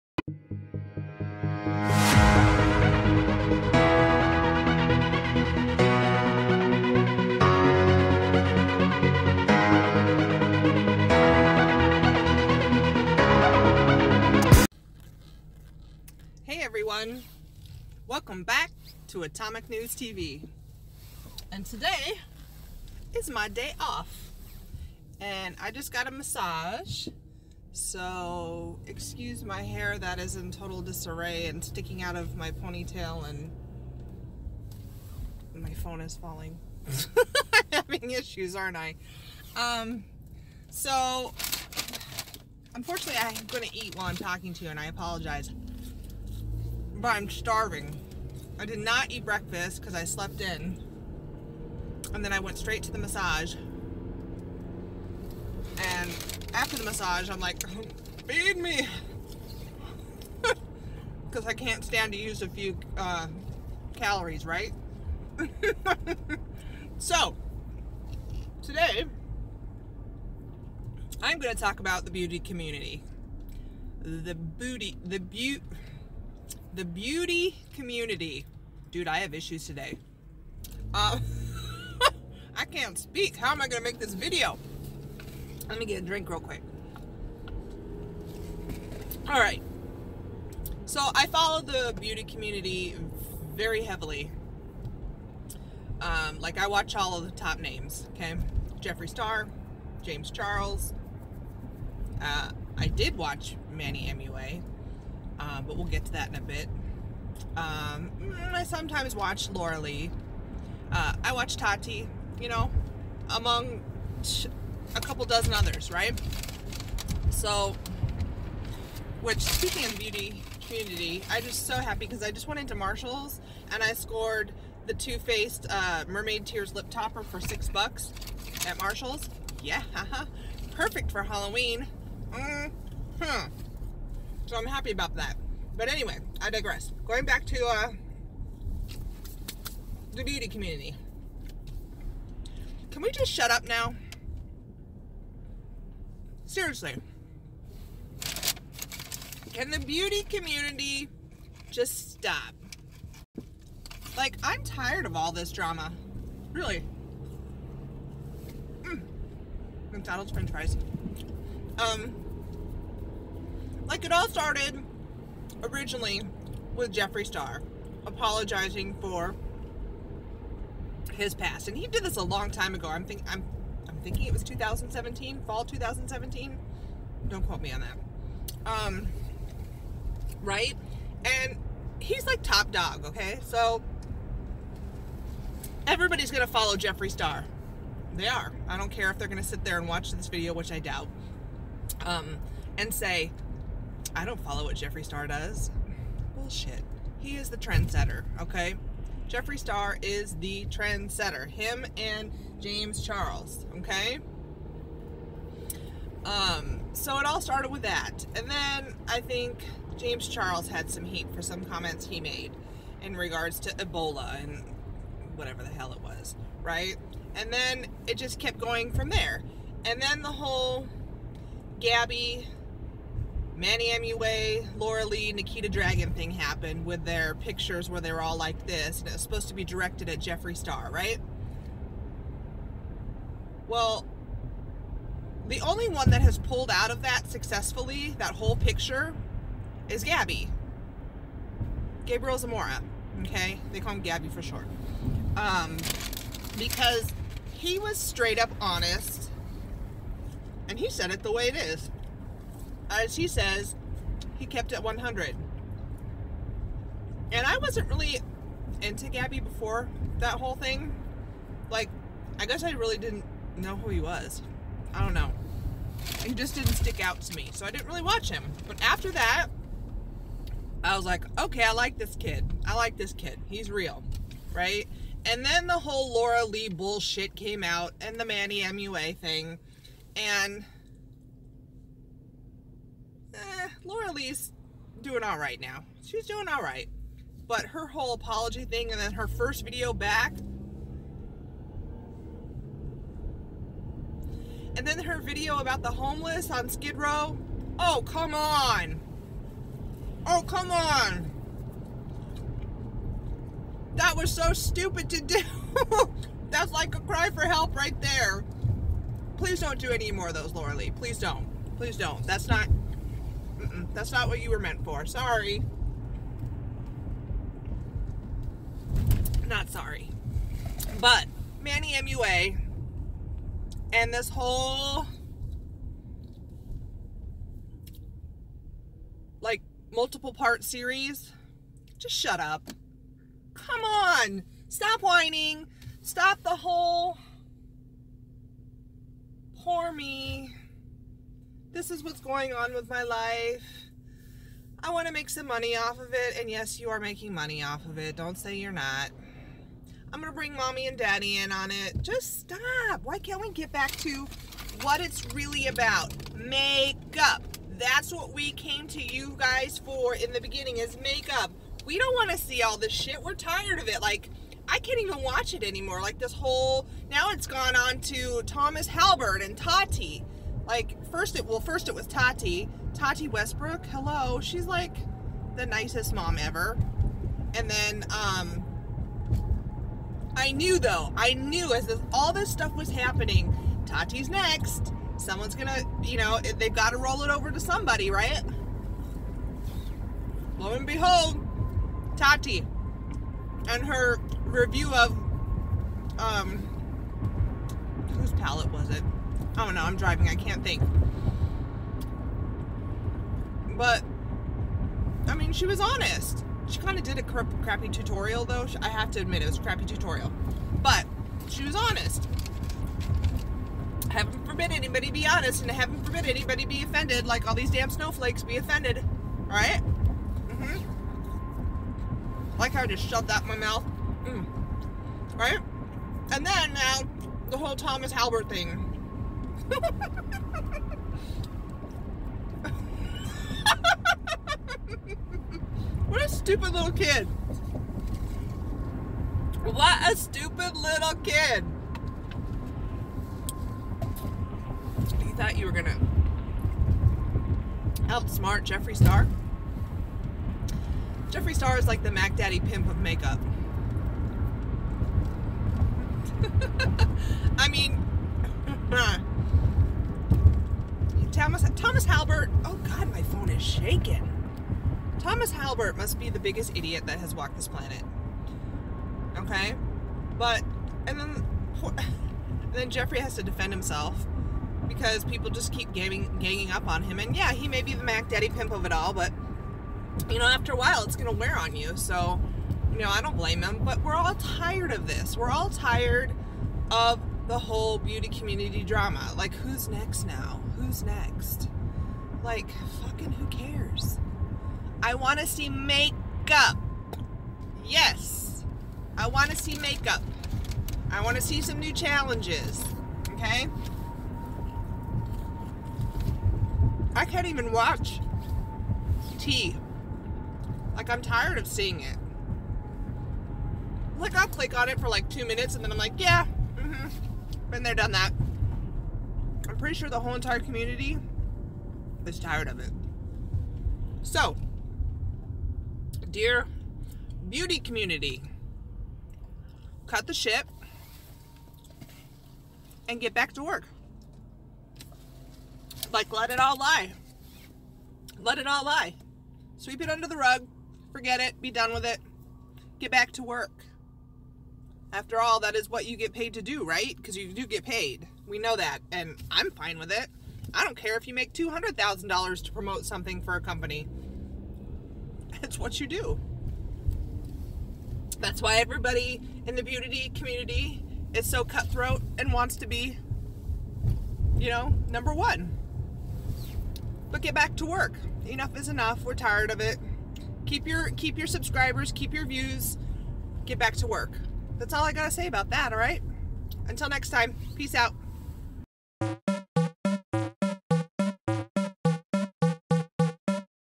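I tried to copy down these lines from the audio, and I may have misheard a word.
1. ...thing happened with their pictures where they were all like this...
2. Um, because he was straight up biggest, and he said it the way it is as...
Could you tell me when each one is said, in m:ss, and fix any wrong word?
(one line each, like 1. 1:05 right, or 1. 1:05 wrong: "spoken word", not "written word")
1. 3:46 right
2. 4:05 wrong: "honest", not "biggest".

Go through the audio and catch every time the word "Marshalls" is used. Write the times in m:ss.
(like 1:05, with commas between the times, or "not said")
2:02, 2:08.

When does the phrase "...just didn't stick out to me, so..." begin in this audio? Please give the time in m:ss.
4:26.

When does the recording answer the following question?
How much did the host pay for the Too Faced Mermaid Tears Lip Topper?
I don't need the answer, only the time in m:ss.
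2:07.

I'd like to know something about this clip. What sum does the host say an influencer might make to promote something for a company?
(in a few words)
$200,000.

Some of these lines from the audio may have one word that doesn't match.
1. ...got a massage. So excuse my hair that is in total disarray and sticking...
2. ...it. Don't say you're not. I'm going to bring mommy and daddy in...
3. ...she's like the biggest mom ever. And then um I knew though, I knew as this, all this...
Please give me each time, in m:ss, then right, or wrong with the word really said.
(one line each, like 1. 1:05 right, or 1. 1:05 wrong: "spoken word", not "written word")
1. 0:25 right
2. 5:47 right
3. 6:14 wrong: "nicest", not "biggest".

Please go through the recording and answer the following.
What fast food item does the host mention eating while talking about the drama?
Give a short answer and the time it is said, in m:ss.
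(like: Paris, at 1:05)
McDonald's french fries, at 2:39.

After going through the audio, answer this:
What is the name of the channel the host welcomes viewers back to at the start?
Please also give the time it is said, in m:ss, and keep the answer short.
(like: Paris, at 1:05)
Atomic News TV, at 0:19.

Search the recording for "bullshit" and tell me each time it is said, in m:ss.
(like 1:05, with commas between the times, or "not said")
3:16, 4:36.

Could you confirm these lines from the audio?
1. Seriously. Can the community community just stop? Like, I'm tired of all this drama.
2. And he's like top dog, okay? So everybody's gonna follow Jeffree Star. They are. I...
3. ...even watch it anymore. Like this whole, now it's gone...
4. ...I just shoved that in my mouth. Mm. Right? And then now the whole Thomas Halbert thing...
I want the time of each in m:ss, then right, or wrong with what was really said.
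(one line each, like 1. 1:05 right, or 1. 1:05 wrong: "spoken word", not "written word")
1. 2:26 wrong: "beauty", not "community"
2. 3:01 right
3. 6:04 right
4. 7:02 right.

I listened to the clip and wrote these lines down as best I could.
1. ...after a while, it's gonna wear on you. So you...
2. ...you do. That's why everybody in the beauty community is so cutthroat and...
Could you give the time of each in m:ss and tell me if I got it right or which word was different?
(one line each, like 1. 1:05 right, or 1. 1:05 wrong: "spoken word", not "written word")
1. 8:00 right
2. 9:15 right.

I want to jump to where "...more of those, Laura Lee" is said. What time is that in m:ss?
5:10.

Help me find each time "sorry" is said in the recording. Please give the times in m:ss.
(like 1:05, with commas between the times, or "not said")
5:15, 5:19.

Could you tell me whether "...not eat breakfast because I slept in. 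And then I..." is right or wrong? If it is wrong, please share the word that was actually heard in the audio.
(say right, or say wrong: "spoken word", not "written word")
right.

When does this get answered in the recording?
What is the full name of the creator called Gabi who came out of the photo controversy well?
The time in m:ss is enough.
4:02.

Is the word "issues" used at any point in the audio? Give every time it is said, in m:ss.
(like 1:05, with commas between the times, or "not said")
0:38, 1:19.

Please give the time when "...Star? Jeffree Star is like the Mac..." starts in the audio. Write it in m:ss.
7:28.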